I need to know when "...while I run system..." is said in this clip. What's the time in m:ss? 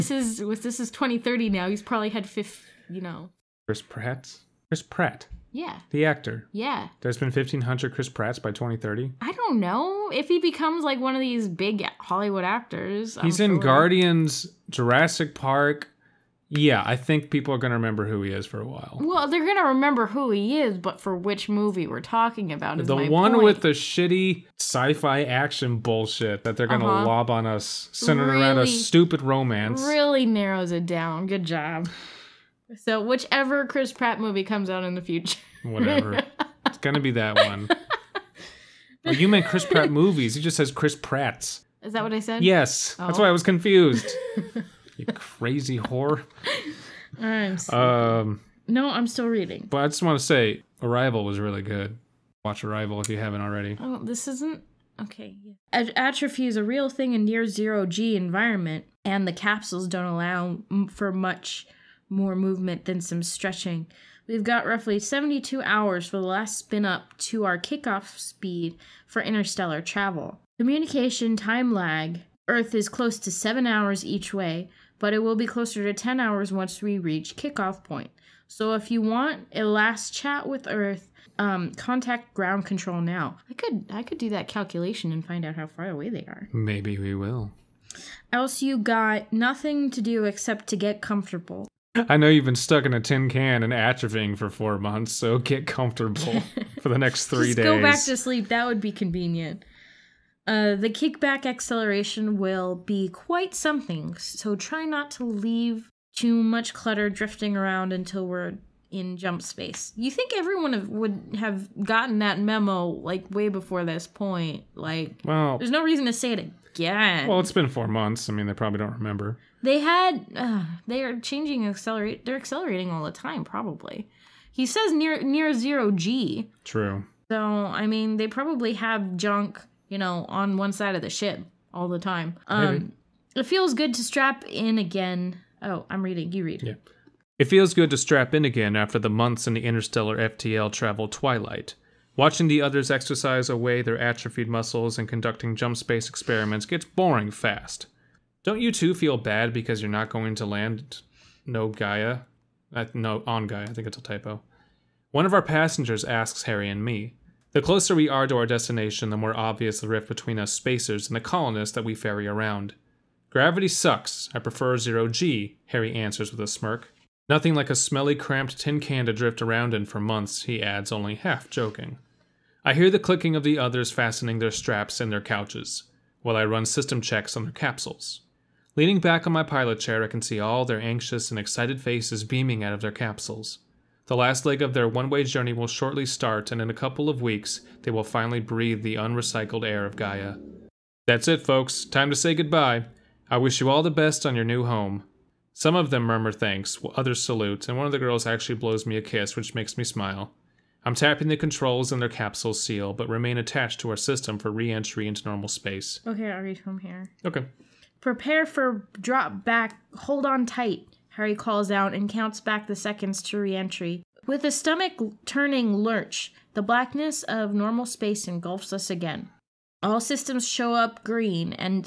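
2:56.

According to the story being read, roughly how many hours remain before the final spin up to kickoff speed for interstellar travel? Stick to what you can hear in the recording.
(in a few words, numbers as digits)
72 hours.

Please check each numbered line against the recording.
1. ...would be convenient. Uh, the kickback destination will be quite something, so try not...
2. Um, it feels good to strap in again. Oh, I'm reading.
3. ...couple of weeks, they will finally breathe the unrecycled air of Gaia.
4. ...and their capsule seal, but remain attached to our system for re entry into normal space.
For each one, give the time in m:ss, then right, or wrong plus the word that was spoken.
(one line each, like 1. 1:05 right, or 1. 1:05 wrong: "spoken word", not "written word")
1. 1:38 wrong: "acceleration", not "destination"
2. 2:12 right
3. 3:06 right
4. 3:21 right.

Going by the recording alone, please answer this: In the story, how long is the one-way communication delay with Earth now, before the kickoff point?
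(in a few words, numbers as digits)
7 hours.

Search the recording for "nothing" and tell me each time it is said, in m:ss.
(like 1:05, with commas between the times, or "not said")
1:29, 2:47.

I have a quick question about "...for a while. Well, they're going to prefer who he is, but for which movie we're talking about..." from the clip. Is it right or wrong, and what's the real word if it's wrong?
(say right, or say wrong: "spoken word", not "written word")
wrong: "remember", not "prefer".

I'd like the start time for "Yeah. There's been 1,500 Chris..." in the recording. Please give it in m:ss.
0:06.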